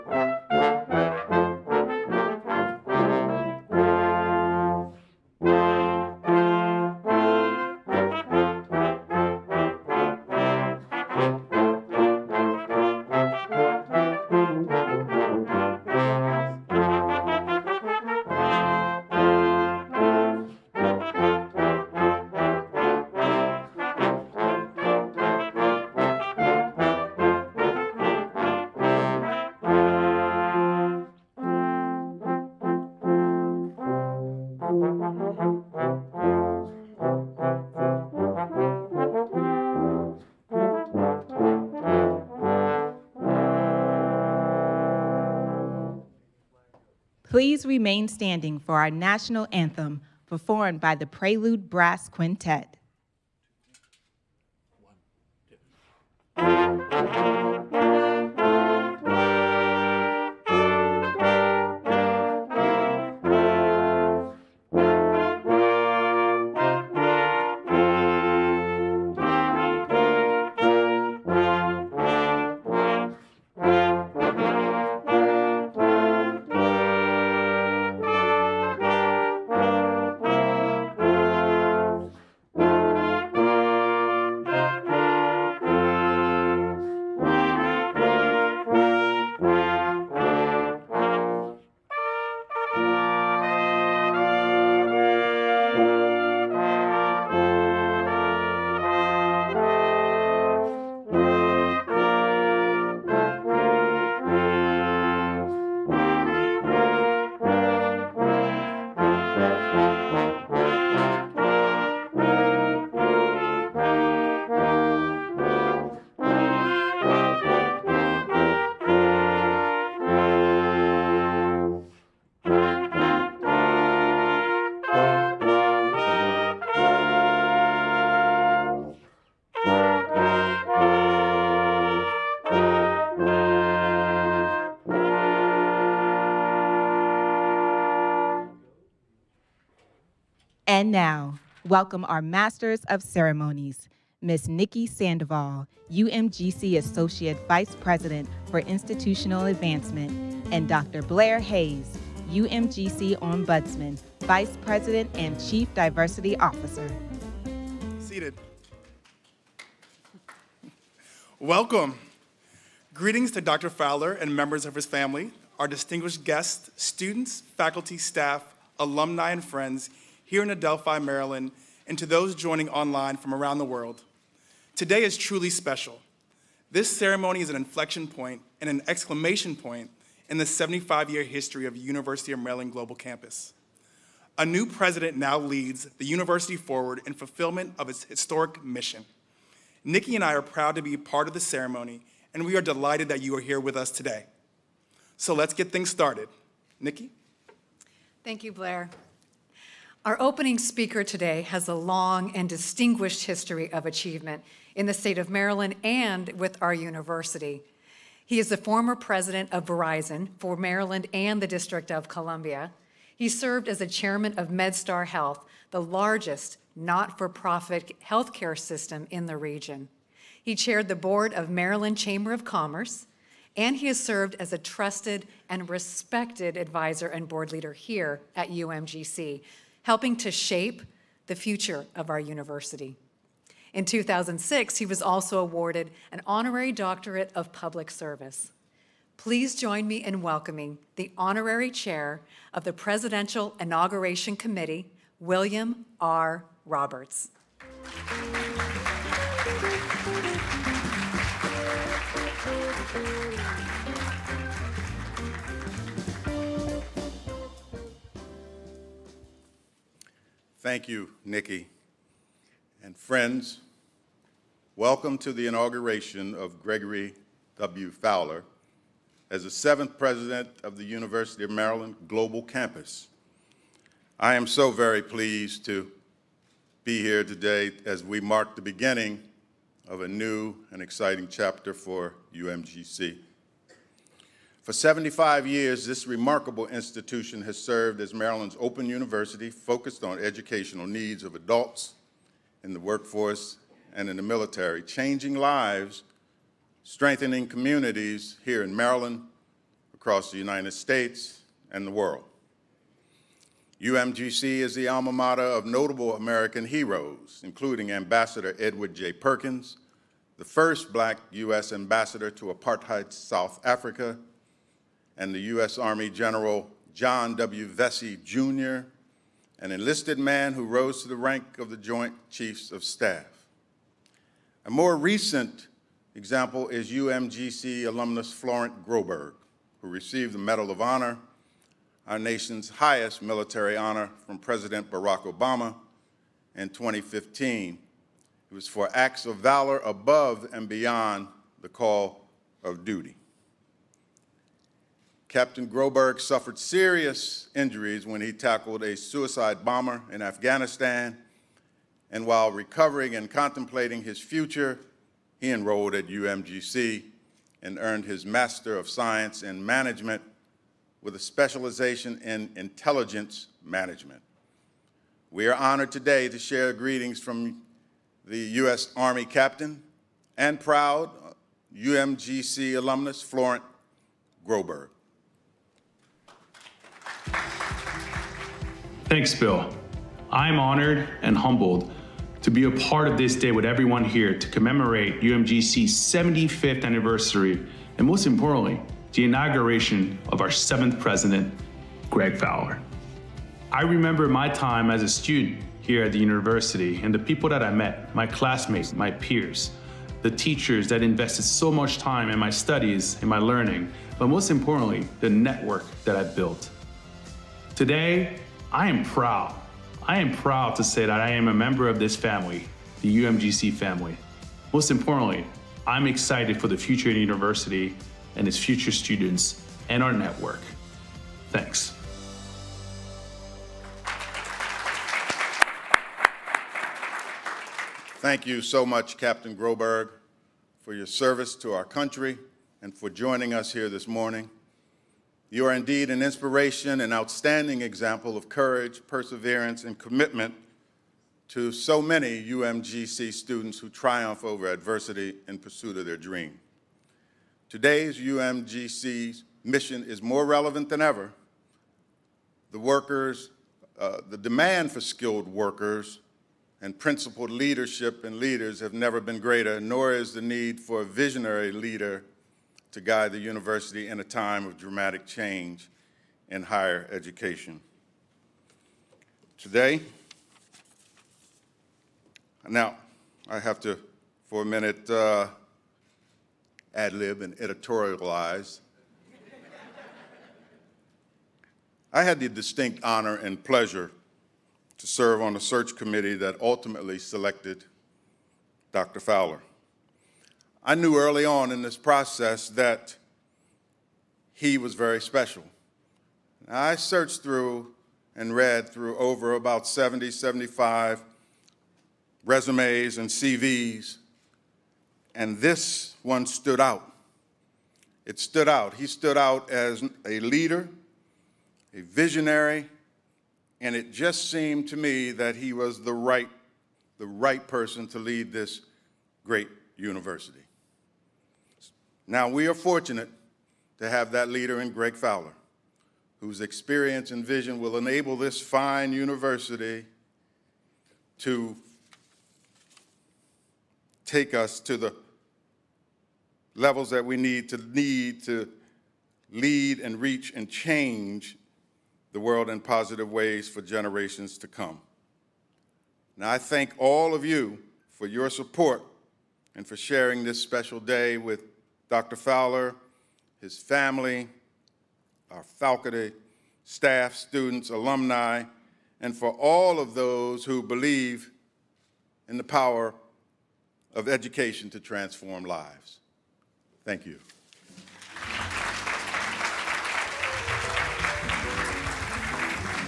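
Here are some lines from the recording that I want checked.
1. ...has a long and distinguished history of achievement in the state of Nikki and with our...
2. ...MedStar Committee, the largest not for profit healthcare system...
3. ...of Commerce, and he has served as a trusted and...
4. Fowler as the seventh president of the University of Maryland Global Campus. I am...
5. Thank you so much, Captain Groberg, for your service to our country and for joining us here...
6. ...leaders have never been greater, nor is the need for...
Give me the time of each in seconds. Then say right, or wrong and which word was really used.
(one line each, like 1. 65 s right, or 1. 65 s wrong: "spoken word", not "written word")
1. 201 s wrong: "Maryland", not "Nikki"
2. 214 s wrong: "Health", not "Committee"
3. 222 s right
4. 267 s right
5. 428 s right
6. 458 s right.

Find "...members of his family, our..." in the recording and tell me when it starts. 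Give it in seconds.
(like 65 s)
164 s.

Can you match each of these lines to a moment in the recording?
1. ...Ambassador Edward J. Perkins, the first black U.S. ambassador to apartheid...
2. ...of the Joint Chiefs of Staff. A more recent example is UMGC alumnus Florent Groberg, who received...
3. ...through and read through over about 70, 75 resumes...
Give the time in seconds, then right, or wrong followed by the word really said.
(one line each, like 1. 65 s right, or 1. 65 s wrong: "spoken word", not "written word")
1. 307 s right
2. 321 s right
3. 497 s right.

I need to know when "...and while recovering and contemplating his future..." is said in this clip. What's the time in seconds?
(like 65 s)
352 s.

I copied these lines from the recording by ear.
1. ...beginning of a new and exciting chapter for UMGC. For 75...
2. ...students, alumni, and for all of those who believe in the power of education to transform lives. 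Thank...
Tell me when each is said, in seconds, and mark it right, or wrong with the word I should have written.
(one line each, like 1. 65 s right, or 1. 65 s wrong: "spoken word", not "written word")
1. 278 s right
2. 557 s right.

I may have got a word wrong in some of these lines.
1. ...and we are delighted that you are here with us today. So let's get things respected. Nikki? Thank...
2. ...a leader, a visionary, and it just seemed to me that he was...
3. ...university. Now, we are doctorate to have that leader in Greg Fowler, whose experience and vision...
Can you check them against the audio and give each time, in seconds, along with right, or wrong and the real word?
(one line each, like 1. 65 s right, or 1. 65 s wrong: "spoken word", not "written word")
1. 192 s wrong: "started", not "respected"
2. 510 s right
3. 519 s wrong: "fortunate", not "doctorate".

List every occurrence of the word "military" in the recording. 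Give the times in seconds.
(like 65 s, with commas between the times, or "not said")
294 s, 333 s.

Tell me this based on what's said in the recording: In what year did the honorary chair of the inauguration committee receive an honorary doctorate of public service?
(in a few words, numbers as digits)
2006.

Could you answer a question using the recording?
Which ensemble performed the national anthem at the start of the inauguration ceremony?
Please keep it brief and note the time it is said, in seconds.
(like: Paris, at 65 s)
Prelude Brass Quintet, at 51 s.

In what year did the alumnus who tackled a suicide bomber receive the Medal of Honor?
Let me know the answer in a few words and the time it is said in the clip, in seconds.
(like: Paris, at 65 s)
2015, at 336 s.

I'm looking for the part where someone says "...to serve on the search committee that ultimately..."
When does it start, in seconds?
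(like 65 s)
484 s.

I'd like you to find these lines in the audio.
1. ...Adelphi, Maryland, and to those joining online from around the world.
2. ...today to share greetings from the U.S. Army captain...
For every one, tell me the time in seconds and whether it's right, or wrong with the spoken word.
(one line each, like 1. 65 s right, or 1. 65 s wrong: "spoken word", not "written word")
1. 170 s right
2. 365 s right.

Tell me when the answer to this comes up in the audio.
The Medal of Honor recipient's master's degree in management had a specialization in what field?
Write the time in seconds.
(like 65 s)
362 s.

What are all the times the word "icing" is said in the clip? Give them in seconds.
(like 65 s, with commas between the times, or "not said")
not said.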